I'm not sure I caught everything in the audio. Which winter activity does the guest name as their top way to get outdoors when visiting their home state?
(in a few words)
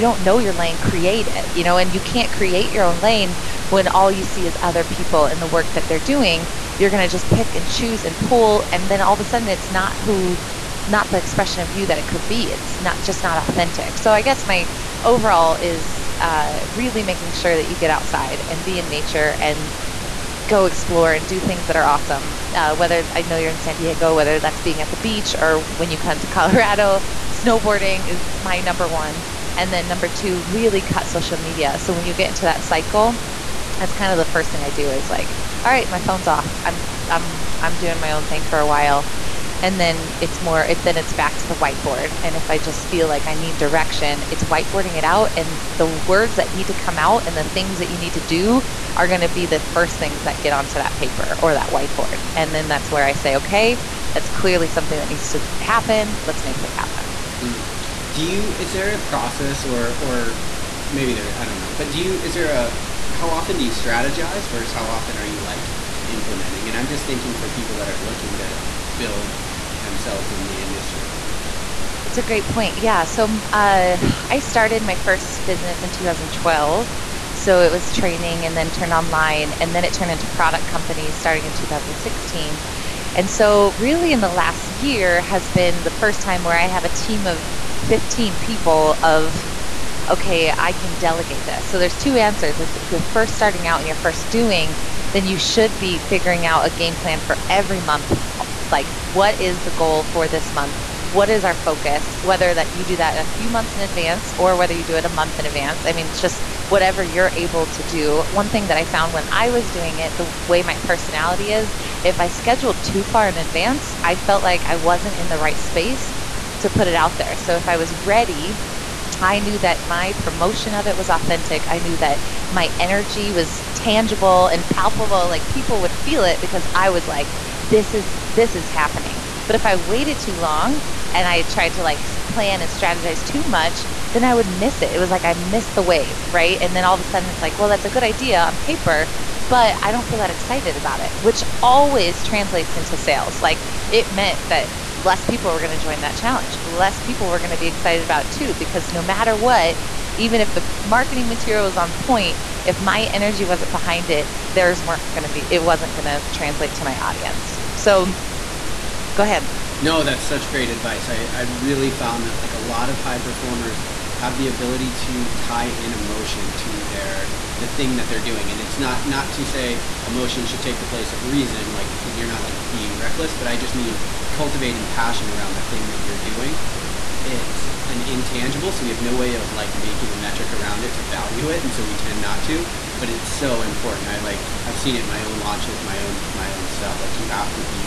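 Snowboarding.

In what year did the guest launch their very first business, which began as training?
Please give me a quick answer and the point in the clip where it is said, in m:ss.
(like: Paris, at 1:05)
2012, at 1:15.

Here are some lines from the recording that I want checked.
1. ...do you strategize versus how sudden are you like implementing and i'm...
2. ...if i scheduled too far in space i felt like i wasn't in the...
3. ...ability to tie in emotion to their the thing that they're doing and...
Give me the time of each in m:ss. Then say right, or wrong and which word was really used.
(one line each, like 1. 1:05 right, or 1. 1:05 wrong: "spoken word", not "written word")
1. 1:03 wrong: "often", not "sudden"
2. 1:52 wrong: "advance", not "space"
3. 2:44 right.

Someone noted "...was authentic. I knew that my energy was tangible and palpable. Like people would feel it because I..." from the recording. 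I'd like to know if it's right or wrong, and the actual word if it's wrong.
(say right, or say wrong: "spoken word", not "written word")
right.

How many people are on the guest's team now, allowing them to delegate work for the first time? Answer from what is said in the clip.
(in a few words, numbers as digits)
15.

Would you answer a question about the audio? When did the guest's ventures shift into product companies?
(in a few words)
2016.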